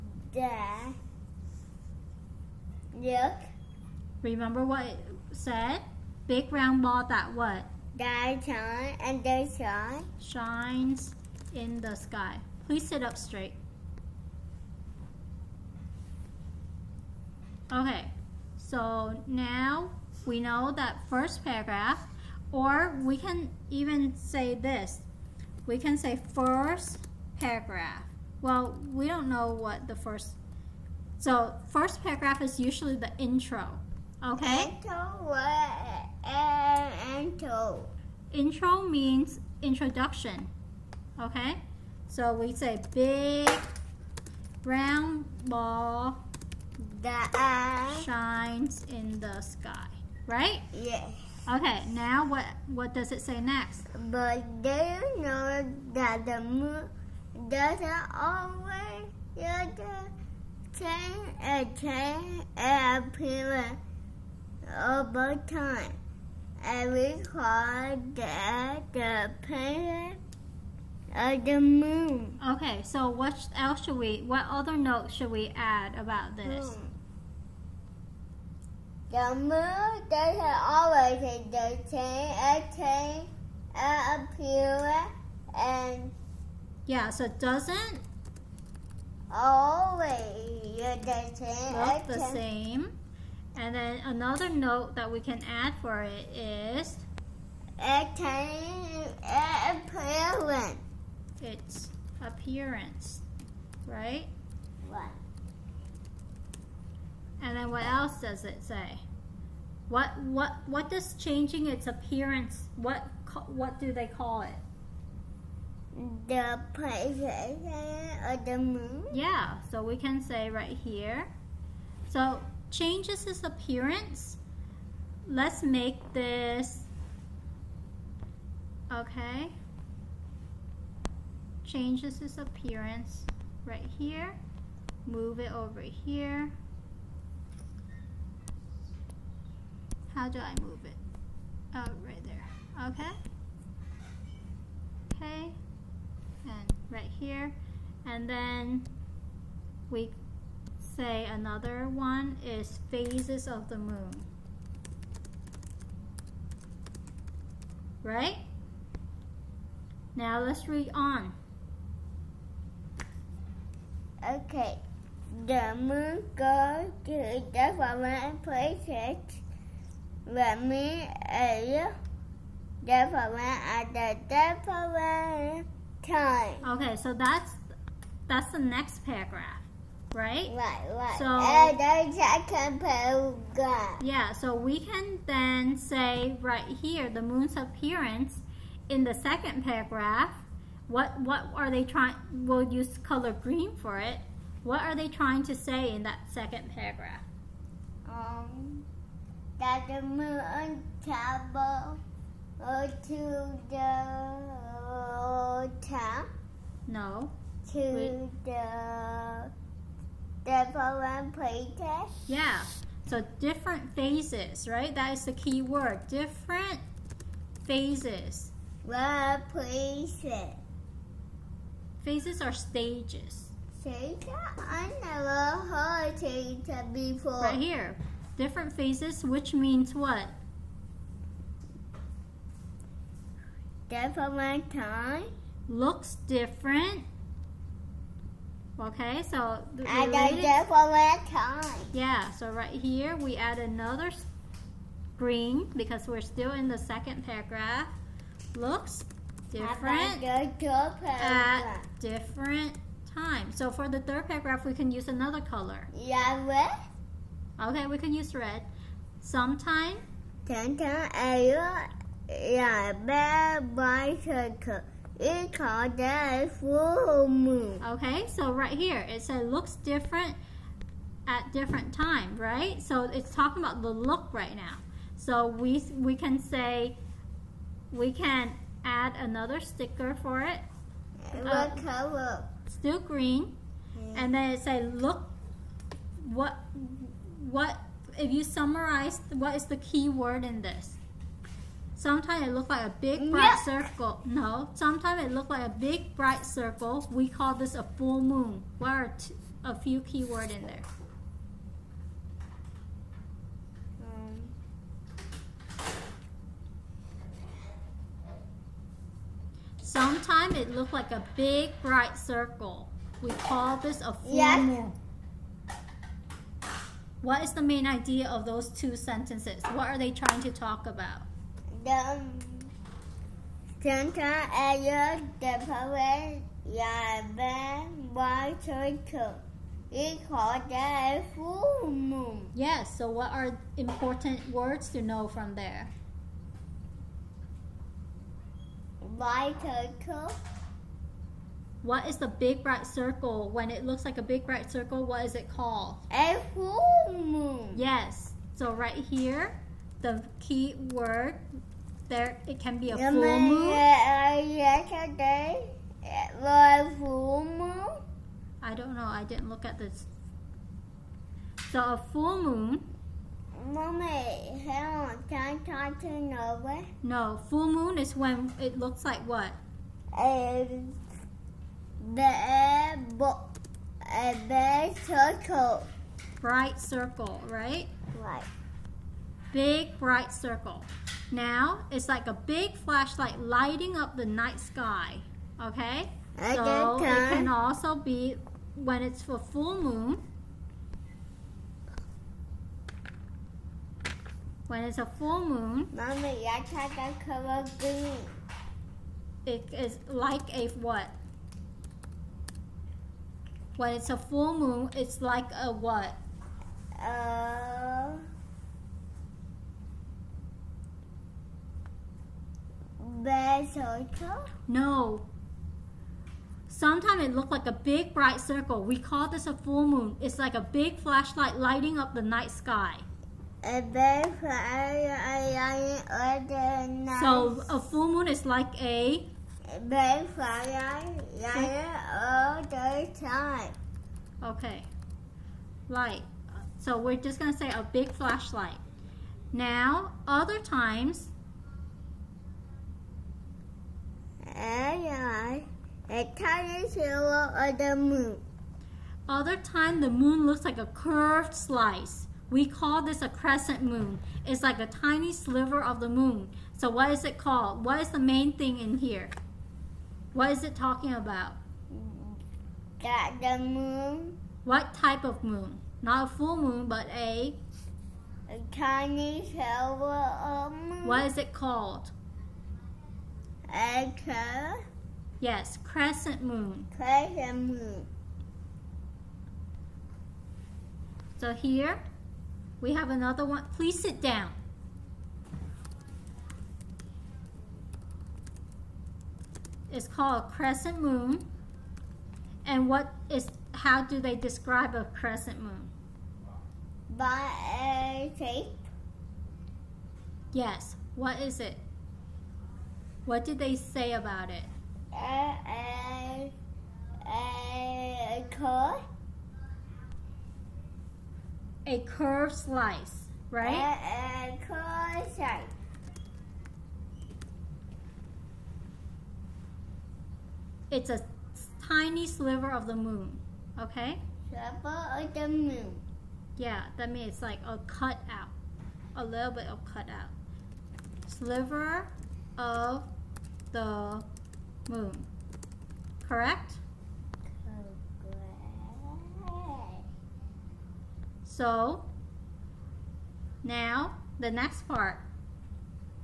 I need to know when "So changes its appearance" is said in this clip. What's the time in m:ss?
2:02.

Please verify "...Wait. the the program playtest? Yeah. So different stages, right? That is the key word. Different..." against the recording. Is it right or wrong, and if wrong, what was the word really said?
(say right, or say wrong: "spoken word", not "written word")
wrong: "phases", not "stages".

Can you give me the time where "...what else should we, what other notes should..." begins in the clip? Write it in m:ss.
1:13.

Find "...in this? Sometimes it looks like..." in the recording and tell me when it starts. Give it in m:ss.
4:50.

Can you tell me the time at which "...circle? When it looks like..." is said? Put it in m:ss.
5:42.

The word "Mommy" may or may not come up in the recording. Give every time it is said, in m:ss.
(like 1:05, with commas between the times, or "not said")
6:03, 6:35.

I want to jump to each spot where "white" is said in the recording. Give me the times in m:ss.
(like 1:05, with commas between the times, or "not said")
5:28, 5:39.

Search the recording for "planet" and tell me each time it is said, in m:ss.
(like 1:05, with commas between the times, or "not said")
1:09.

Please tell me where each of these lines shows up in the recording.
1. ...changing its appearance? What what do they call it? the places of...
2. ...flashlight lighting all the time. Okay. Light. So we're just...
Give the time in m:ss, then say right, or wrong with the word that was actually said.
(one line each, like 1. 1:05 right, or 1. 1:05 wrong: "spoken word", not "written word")
1. 1:51 right
2. 7:10 right.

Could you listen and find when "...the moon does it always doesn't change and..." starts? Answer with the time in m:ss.
0:56.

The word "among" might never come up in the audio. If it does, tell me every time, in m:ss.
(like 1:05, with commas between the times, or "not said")
not said.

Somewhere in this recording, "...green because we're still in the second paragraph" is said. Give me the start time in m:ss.
4:05.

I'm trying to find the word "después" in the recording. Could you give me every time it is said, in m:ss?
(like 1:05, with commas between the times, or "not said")
5:25.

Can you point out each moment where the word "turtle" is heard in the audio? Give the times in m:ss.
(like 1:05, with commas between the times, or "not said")
5:28, 5:39.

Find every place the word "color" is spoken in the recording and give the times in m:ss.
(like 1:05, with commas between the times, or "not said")
3:13, 4:15, 4:41, 6:37.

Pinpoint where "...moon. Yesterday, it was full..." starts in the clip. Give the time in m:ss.
5:53.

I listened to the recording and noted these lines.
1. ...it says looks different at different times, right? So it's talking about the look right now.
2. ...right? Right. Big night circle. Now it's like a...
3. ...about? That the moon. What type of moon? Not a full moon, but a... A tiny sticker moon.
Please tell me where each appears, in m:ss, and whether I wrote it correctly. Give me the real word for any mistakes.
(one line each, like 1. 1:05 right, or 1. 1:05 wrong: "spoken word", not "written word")
1. 4:29 right
2. 6:17 wrong: "bright", not "night"
3. 7:41 wrong: "silver", not "sticker".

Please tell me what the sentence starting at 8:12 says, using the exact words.
And what is how do they describe a crescent moon?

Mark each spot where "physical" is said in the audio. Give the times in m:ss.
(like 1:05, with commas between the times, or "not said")
not said.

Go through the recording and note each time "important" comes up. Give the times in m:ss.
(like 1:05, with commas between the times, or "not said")
5:33.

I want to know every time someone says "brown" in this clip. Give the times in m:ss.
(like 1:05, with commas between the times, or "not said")
0:44.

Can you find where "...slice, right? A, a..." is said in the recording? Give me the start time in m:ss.
8:32.